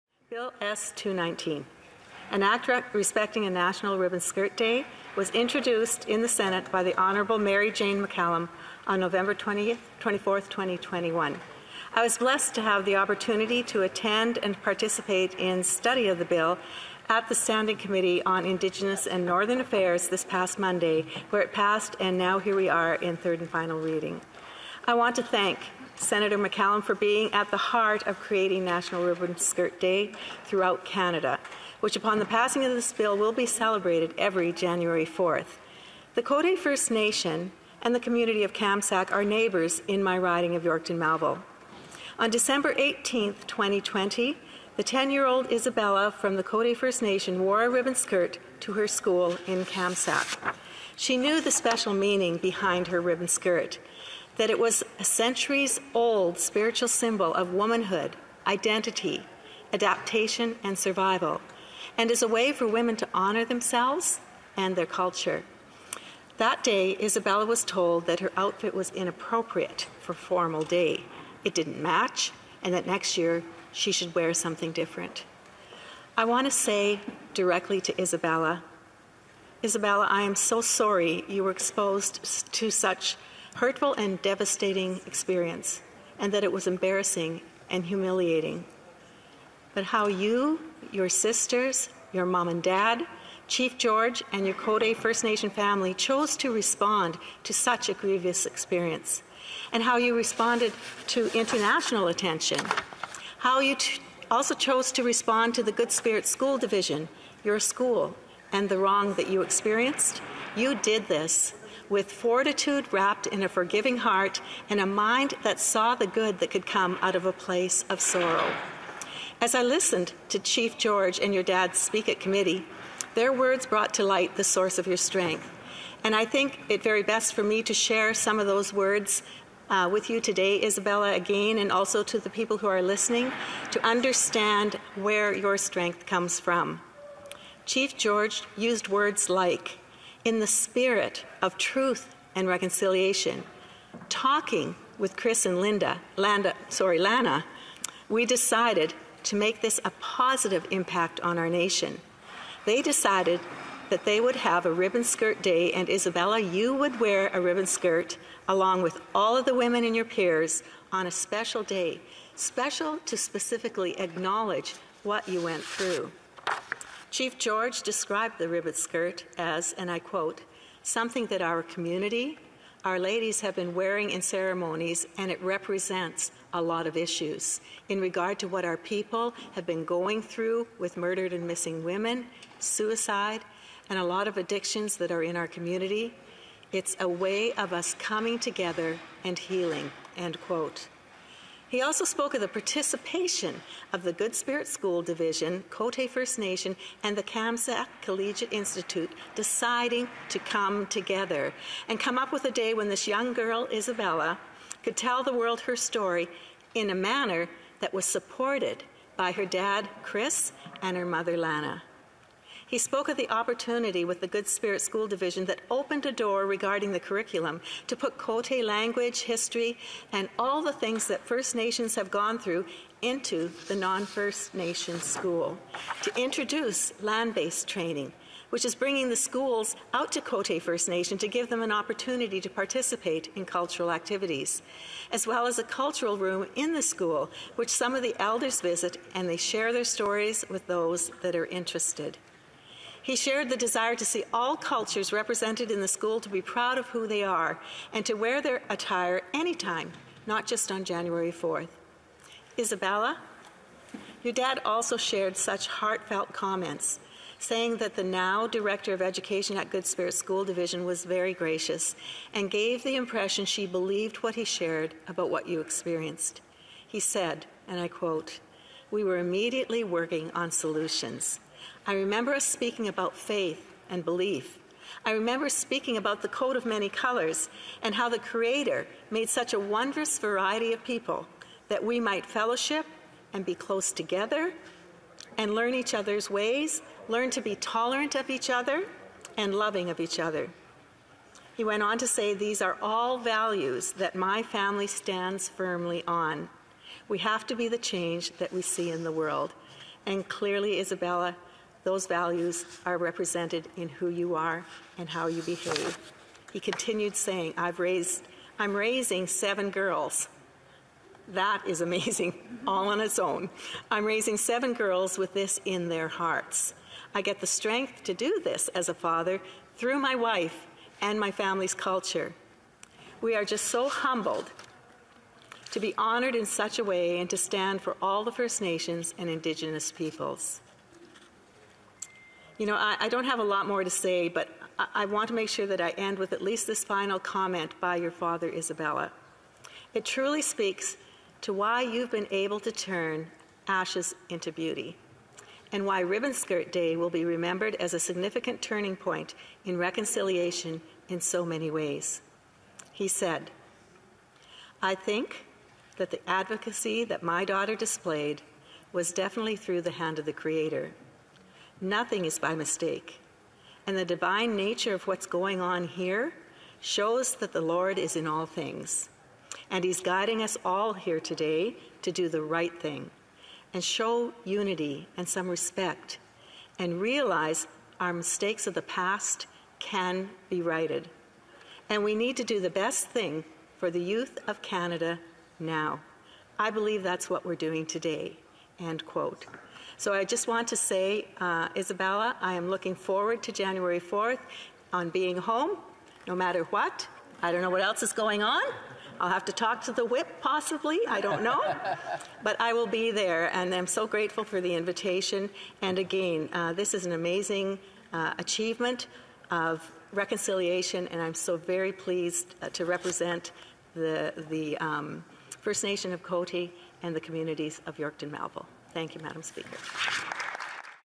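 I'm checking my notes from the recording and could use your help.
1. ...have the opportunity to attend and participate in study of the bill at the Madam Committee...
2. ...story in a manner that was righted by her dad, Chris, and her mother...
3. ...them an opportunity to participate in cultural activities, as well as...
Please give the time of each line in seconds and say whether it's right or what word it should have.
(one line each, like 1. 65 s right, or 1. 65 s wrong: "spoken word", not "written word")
1. 12 s wrong: "Standing", not "Madam"
2. 205 s wrong: "supported", not "righted"
3. 231 s right.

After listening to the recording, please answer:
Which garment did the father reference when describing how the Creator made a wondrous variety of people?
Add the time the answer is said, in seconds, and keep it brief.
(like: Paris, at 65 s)
coat of many colors, at 276 s.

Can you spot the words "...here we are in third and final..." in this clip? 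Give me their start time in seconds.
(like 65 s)
22 s.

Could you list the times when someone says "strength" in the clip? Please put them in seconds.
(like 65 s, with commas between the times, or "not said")
124 s, 135 s, 317 s.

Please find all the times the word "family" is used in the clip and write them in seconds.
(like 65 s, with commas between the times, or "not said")
95 s, 294 s, 321 s.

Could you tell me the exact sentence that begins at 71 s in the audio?
It didn't match, and that next year she should wear something different.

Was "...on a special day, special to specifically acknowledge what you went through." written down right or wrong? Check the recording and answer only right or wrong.
right.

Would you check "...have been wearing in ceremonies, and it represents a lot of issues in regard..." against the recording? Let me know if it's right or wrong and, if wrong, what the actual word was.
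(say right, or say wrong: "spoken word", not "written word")
right.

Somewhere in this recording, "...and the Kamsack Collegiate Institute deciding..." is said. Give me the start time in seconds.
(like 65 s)
197 s.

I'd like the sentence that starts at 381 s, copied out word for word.
And we need to do the best thing for the youth of Canada now.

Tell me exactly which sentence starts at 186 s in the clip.
It's a way of us coming together and healing, end quote.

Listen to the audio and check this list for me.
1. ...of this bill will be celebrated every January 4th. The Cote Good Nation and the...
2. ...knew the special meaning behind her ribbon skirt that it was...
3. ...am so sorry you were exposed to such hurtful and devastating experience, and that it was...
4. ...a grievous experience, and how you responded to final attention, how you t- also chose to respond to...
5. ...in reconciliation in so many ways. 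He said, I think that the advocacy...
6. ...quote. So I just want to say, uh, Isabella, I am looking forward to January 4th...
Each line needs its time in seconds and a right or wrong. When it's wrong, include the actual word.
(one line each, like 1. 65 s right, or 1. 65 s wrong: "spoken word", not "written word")
1. 32 s wrong: "First", not "Good"
2. 51 s right
3. 80 s right
4. 97 s wrong: "international", not "final"
5. 349 s right
6. 389 s right.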